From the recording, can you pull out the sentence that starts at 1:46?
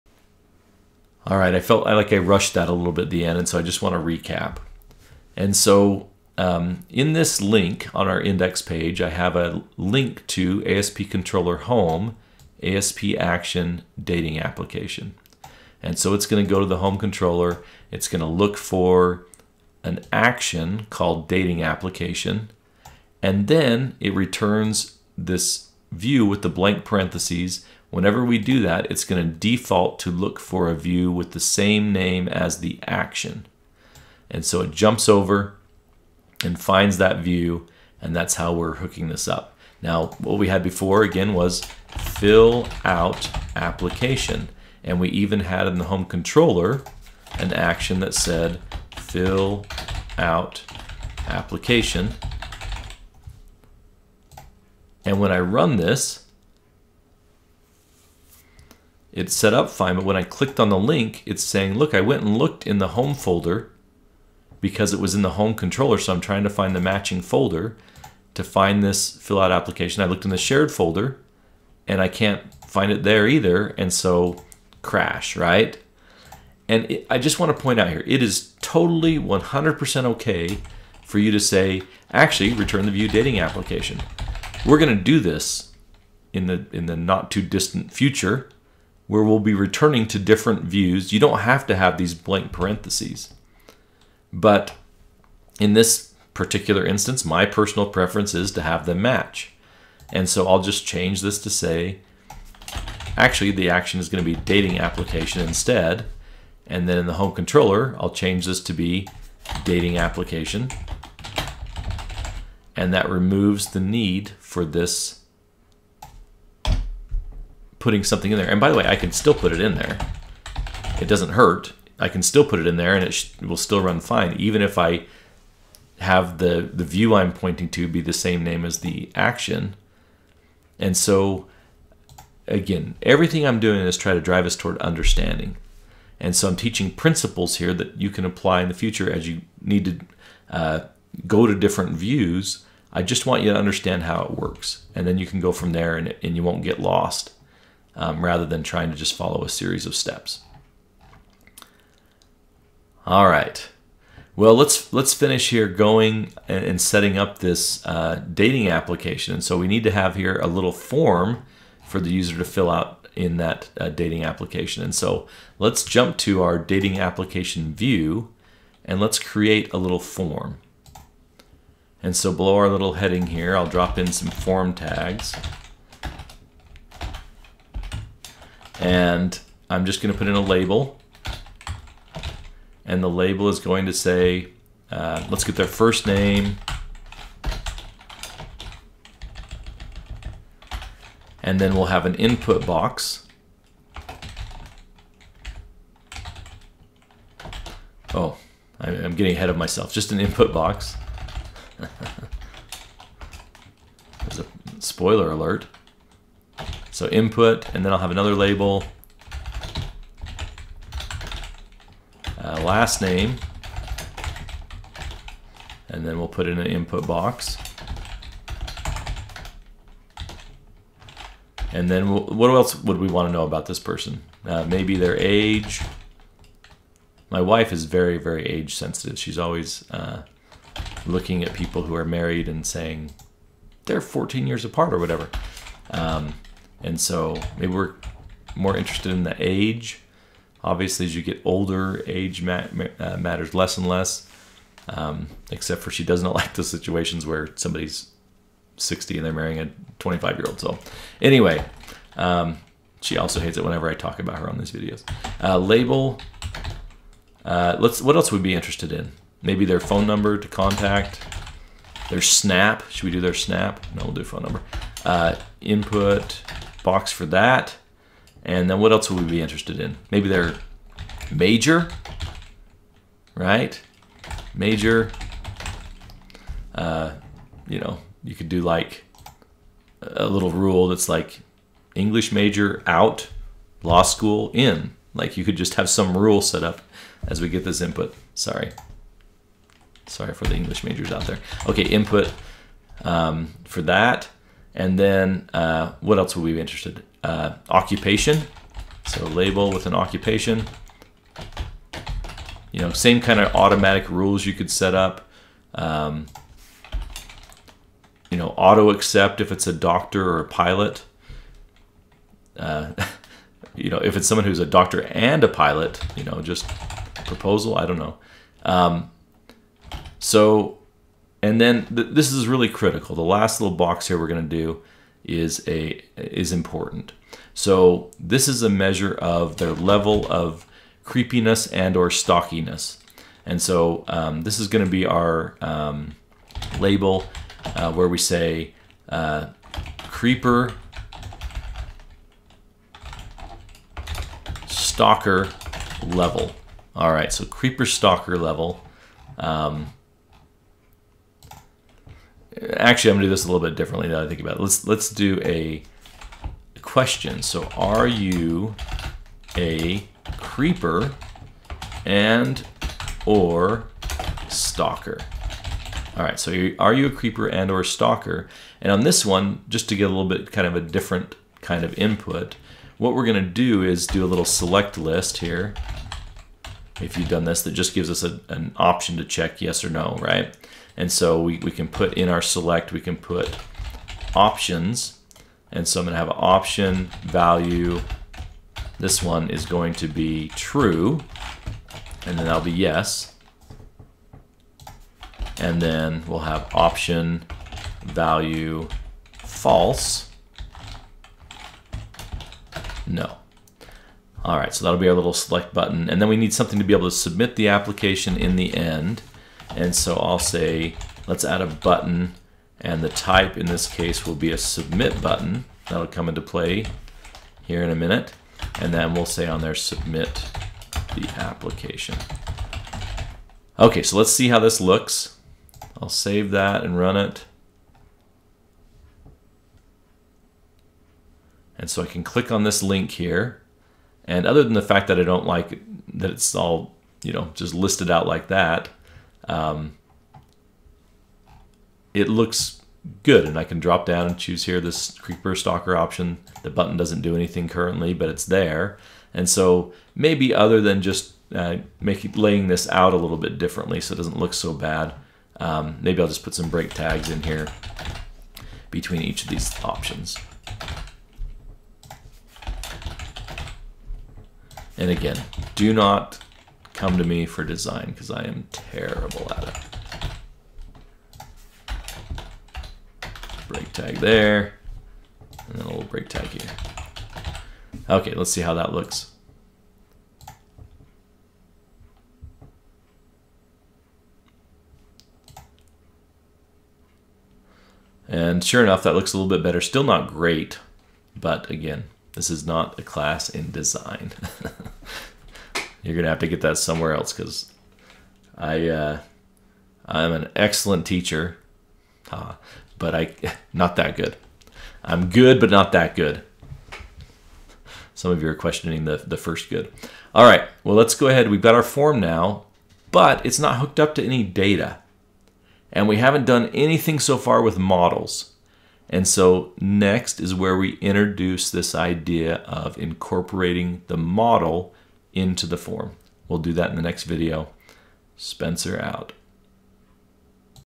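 And then in the home controller, I'll change this to be dating application.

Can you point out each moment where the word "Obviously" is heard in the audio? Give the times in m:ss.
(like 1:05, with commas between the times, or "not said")
4:00.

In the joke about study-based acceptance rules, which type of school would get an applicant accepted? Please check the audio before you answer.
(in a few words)
Law school.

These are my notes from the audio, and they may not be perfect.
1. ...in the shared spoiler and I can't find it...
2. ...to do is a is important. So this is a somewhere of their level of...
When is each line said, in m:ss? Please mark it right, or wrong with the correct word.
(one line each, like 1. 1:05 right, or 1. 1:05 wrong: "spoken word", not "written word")
1. 1:10 wrong: "folder", not "spoiler"
2. 5:24 wrong: "measure", not "somewhere".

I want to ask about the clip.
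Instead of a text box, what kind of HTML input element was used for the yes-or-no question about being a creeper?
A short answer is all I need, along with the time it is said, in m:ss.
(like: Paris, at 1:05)
Select list, at 6:14.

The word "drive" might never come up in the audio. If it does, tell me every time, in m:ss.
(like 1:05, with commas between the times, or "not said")
2:14.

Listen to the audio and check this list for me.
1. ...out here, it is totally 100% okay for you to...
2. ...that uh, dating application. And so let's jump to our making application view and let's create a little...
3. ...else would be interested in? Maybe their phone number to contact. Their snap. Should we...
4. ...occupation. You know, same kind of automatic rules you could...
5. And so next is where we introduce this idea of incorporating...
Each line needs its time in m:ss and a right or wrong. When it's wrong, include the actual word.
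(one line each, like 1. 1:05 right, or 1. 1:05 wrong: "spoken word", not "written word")
1. 1:17 right
2. 2:43 wrong: "dating", not "making"
3. 4:18 right
4. 4:59 right
5. 8:39 right.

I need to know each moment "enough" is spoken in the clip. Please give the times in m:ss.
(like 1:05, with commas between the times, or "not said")
8:08.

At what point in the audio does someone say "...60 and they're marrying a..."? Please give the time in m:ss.
4:08.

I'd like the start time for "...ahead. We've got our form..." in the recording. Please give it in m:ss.
8:31.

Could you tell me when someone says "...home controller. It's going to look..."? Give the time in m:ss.
0:16.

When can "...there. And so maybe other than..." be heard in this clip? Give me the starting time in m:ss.
7:28.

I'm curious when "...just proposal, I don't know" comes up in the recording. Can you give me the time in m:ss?
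5:16.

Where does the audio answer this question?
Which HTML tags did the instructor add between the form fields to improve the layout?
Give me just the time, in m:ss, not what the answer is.
7:36.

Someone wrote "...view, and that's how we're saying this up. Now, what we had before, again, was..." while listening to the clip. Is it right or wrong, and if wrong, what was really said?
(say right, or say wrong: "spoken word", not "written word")
wrong: "hooking", not "saying".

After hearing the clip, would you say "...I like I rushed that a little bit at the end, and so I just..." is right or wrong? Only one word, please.
right.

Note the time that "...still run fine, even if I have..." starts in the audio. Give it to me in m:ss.
2:03.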